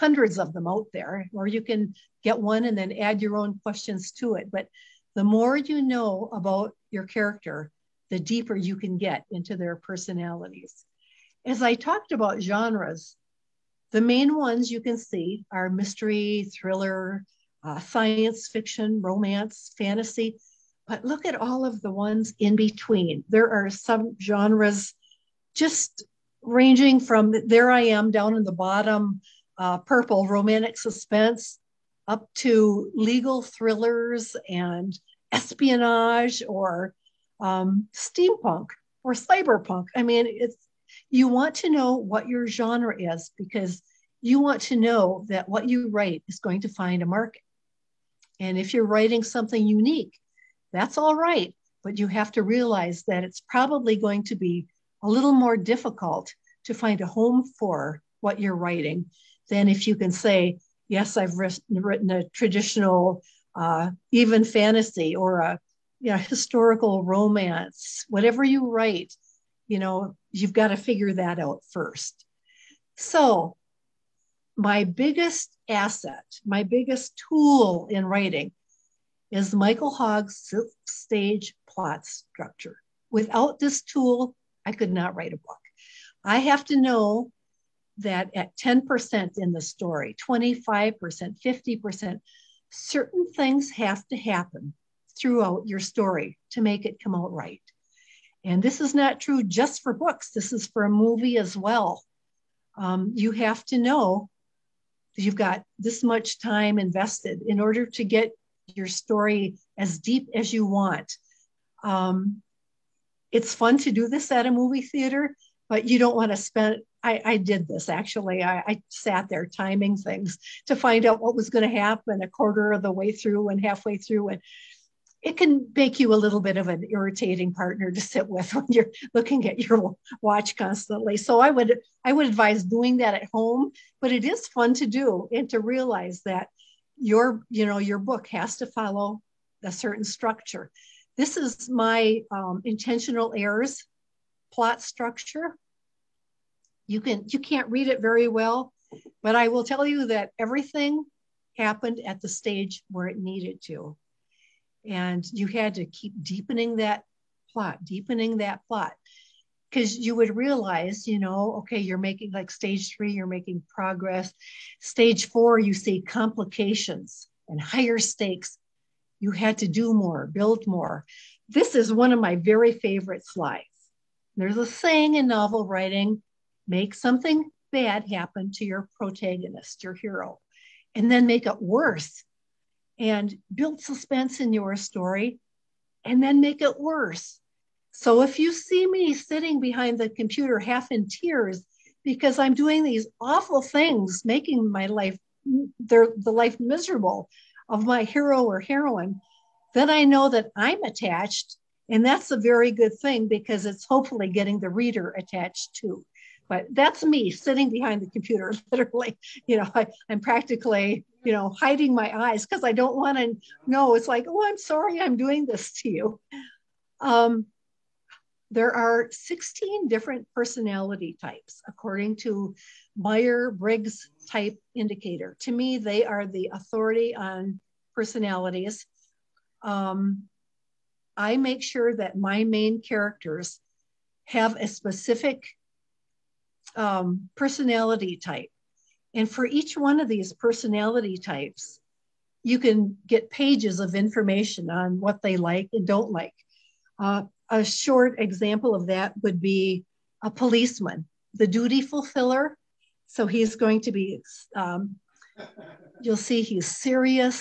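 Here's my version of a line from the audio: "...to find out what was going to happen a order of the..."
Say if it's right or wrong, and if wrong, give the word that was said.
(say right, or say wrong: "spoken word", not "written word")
wrong: "quarter", not "order".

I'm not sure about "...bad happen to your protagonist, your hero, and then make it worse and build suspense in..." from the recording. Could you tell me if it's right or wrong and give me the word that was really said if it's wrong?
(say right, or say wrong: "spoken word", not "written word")
right.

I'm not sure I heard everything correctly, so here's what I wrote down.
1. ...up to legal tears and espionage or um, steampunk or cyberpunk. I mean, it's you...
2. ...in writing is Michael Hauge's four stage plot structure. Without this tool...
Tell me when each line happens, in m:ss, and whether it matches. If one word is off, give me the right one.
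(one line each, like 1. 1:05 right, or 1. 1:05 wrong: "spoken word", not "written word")
1. 0:32 wrong: "thrillers", not "tears"
2. 1:17 wrong: "six", not "four".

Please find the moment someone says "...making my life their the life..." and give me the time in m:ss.
3:14.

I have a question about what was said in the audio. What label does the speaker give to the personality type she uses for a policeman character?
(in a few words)
the duty fulfiller.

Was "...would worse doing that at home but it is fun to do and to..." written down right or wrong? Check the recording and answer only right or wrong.
wrong.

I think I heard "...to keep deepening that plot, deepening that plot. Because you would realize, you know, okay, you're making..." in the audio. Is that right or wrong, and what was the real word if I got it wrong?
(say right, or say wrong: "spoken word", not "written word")
right.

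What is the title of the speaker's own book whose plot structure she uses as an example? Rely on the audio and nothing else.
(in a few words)
Intentional Heirs.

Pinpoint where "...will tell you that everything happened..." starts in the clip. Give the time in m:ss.
2:29.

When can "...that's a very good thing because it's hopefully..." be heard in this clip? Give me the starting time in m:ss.
3:22.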